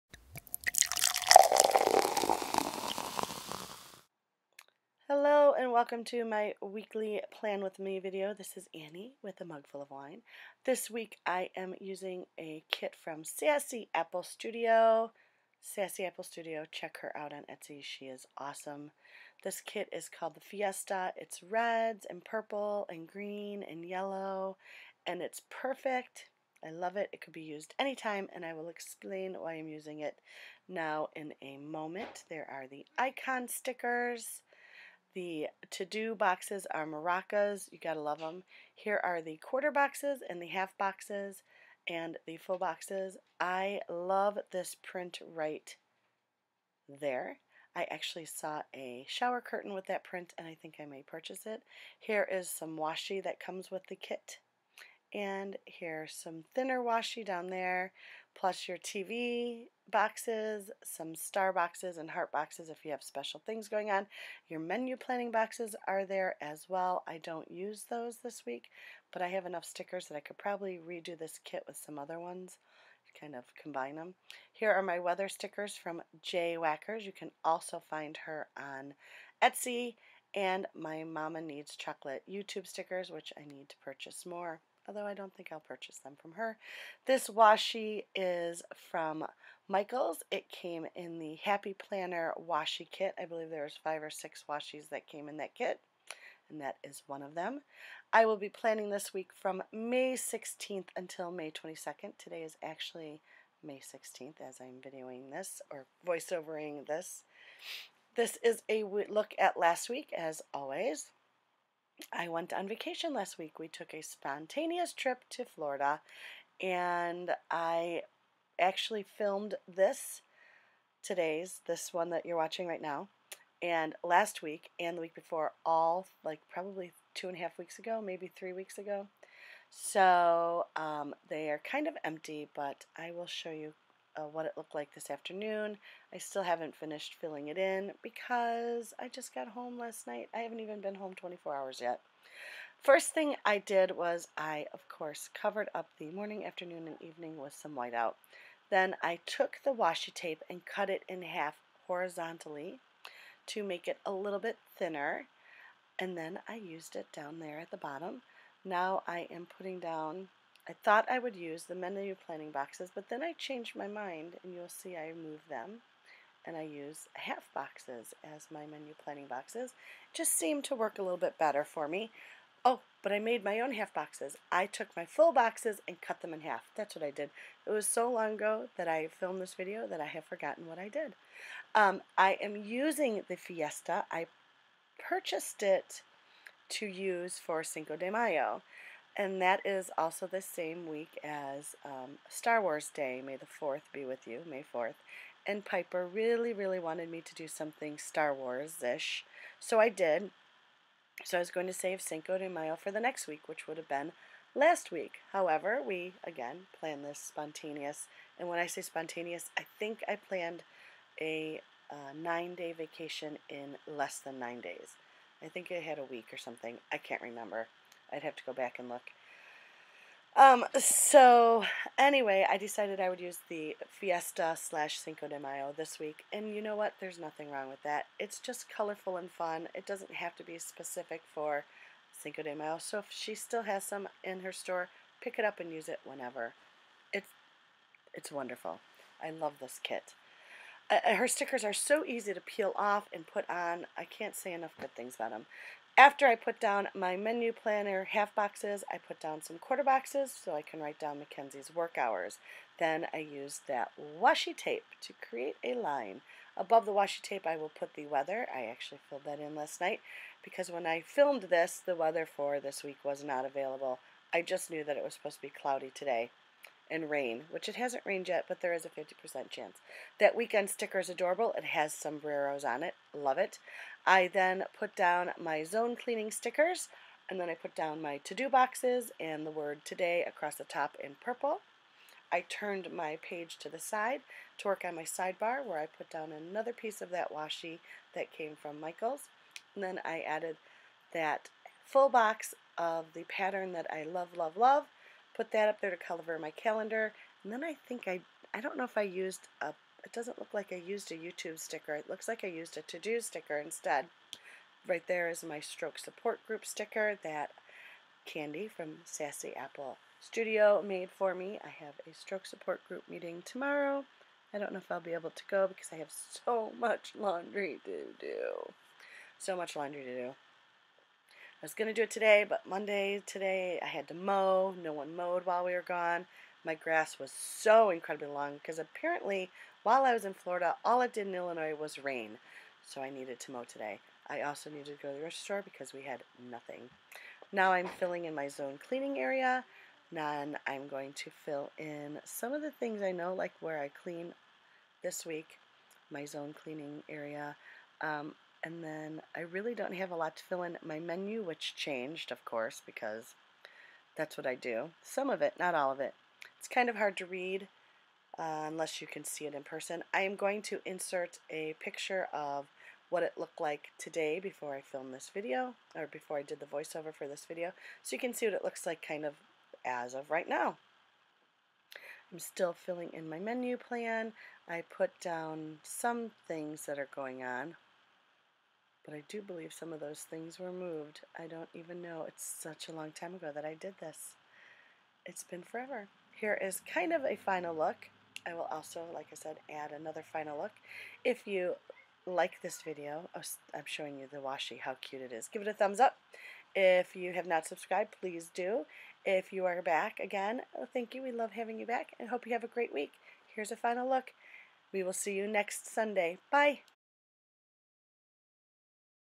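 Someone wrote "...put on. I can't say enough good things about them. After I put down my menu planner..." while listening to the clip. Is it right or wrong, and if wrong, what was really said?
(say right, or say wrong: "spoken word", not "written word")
right.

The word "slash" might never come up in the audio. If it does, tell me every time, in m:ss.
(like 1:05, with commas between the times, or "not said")
3:44.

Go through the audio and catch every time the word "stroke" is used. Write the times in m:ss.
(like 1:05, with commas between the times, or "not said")
5:05, 5:12.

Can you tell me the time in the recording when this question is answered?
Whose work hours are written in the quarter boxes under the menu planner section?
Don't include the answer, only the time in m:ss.
4:11.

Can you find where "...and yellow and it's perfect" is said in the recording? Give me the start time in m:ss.
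0:23.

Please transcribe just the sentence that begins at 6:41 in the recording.
We love having you back and hope you have a great week.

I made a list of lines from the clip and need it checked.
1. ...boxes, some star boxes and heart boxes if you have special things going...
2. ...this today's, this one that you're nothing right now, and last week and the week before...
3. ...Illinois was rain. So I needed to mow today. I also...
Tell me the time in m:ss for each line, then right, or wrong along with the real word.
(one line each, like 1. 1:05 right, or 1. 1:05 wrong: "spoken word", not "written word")
1. 0:59 right
2. 1:59 wrong: "watching", not "nothing"
3. 5:31 right.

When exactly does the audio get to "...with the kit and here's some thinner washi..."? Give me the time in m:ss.
0:53.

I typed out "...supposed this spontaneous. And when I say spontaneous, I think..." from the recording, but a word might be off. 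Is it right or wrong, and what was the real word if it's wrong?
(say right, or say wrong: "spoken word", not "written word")
wrong: "planned", not "supposed".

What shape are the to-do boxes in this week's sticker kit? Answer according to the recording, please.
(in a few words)
Maracas.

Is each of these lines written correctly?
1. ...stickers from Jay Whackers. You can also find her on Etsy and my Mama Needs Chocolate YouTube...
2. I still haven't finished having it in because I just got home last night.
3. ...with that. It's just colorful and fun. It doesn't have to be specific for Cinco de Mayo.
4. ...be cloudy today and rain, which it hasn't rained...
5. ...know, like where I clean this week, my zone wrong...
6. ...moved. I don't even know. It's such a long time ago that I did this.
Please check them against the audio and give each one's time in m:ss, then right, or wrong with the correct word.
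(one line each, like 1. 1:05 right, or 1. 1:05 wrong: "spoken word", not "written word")
1. 1:15 right
2. 2:16 wrong: "filling", not "having"
3. 3:47 right
4. 4:25 right
5. 5:43 wrong: "cleaning", not "wrong"
6. 6:20 right.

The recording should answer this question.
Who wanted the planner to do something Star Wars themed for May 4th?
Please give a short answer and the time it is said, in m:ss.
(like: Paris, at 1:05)
Piper, at 3:15.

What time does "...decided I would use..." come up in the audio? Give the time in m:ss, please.
3:42.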